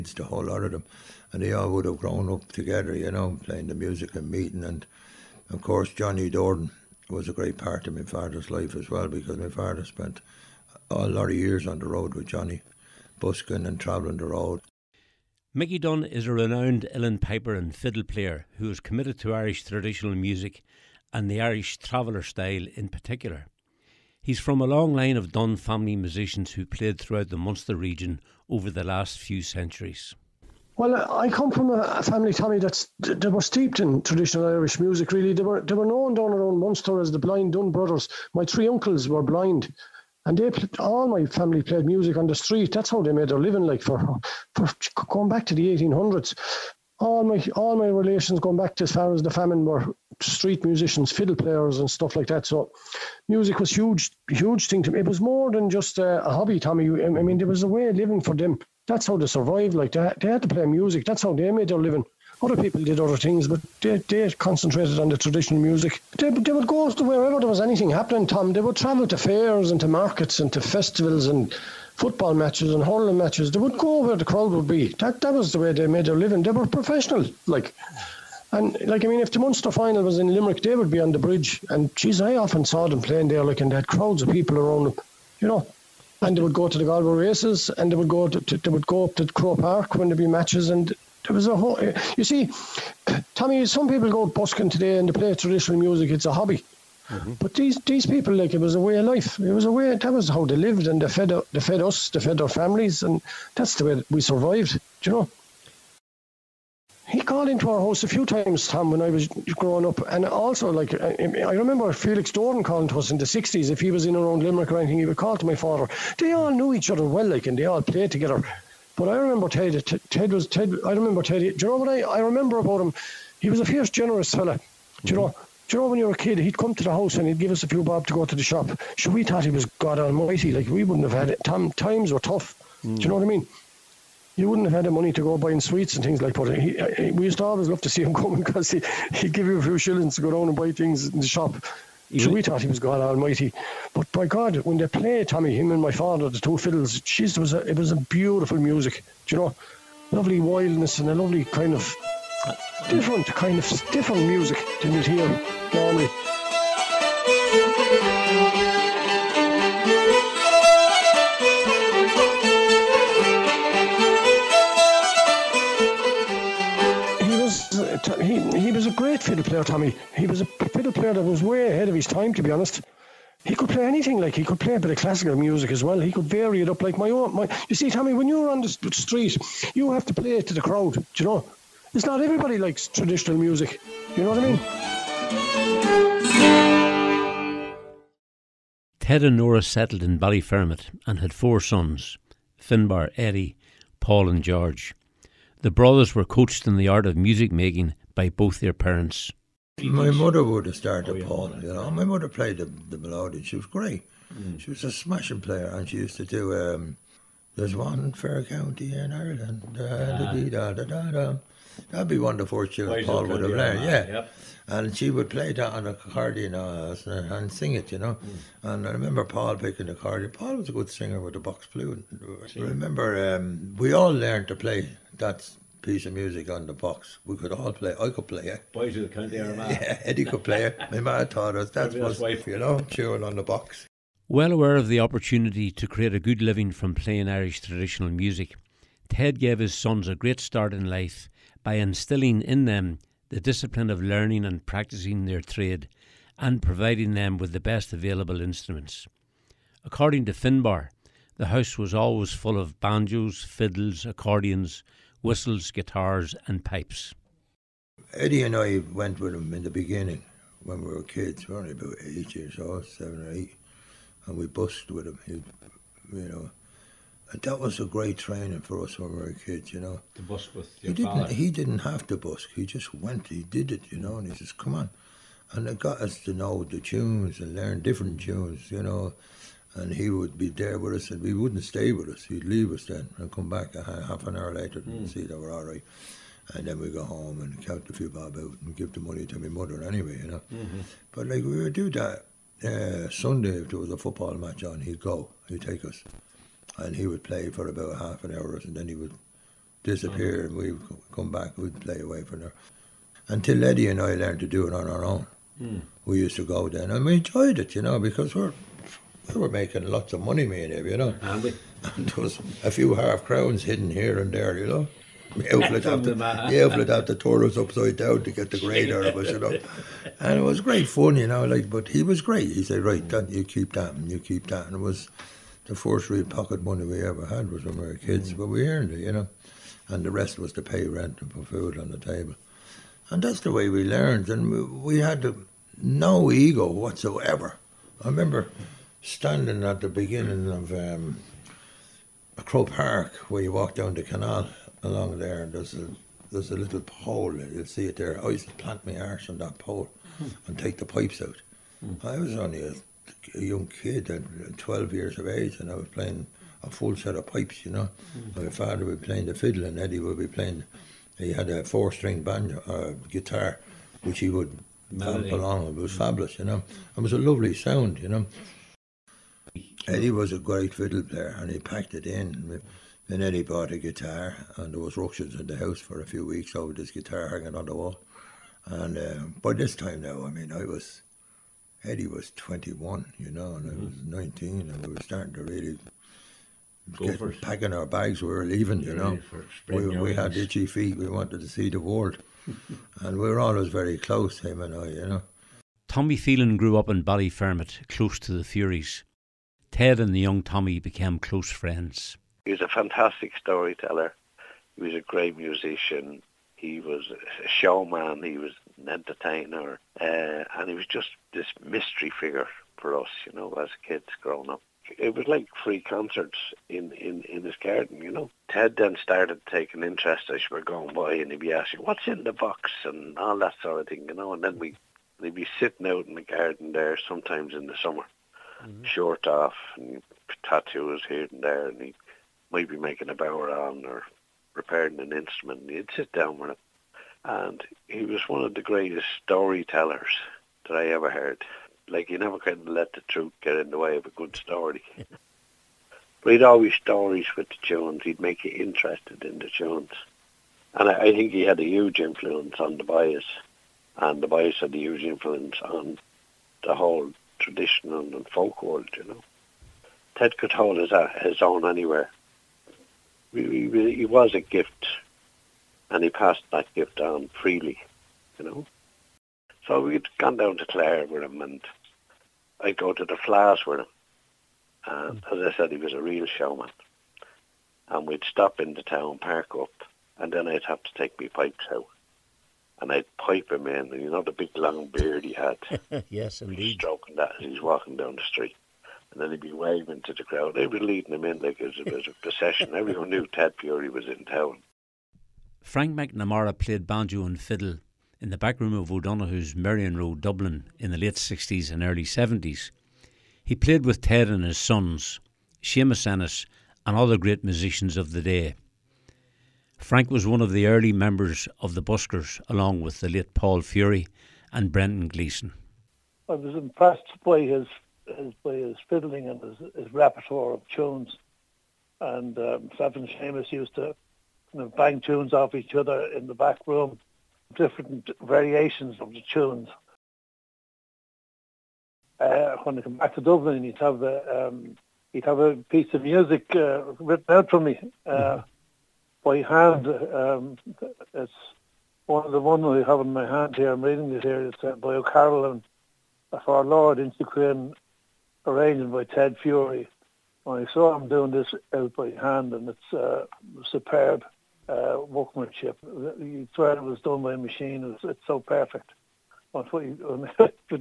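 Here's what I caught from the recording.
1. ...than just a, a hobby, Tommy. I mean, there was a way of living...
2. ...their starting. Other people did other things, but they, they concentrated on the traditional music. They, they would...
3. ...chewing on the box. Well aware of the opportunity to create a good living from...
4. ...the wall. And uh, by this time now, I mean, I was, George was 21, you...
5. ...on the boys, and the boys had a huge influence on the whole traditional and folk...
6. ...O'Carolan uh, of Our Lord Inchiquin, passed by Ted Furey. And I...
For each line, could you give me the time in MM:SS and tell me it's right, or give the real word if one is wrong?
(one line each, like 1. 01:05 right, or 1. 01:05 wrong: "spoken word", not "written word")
1. 00:55 right
2. 01:01 wrong: "living", not "starting"
3. 03:52 right
4. 06:17 wrong: "Eddie", not "George"
5. 07:32 right
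6. 09:04 wrong: "arranged", not "passed".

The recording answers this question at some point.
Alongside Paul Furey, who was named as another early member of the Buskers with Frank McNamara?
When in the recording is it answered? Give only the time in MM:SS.
08:34.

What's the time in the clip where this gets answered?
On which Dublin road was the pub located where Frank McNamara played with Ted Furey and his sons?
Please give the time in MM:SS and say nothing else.
08:19.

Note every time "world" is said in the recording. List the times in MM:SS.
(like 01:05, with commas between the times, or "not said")
06:31, 07:38.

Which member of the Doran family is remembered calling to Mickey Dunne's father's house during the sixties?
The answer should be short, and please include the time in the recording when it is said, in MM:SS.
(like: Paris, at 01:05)
Felix Doran, at 01:51.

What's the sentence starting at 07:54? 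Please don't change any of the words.
And as I said, he was a real showman.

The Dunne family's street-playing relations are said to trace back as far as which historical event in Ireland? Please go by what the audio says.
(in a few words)
The famine.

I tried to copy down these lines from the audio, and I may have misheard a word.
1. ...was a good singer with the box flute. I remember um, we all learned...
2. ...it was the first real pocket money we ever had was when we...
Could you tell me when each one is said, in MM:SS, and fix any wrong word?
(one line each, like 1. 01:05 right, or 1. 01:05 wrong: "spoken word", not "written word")
1. 03:40 right
2. 05:24 right.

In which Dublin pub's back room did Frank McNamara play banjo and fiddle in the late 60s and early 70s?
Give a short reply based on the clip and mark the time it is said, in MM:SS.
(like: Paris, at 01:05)
O'Donoghue's, at 08:18.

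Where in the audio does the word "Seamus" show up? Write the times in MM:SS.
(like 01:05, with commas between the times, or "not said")
08:25, 08:43.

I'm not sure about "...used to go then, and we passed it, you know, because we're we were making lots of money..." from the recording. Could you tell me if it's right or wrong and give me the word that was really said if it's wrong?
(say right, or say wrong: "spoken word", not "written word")
wrong: "enjoyed", not "passed".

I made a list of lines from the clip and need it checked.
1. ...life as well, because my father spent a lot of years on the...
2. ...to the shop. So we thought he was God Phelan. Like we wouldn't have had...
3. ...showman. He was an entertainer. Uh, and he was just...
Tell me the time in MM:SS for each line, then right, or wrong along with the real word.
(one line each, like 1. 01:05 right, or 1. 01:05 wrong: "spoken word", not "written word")
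1. 00:08 right
2. 02:08 wrong: "Almighty", not "Phelan"
3. 06:47 right.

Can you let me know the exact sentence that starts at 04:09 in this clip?
According to Finbar, the house was always full of banjos, fiddles, accordions, whistles, guitars, and pipes.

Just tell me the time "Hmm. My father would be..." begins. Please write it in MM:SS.
05:58.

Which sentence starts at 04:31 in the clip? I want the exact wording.
didn't, He didn't have to busk.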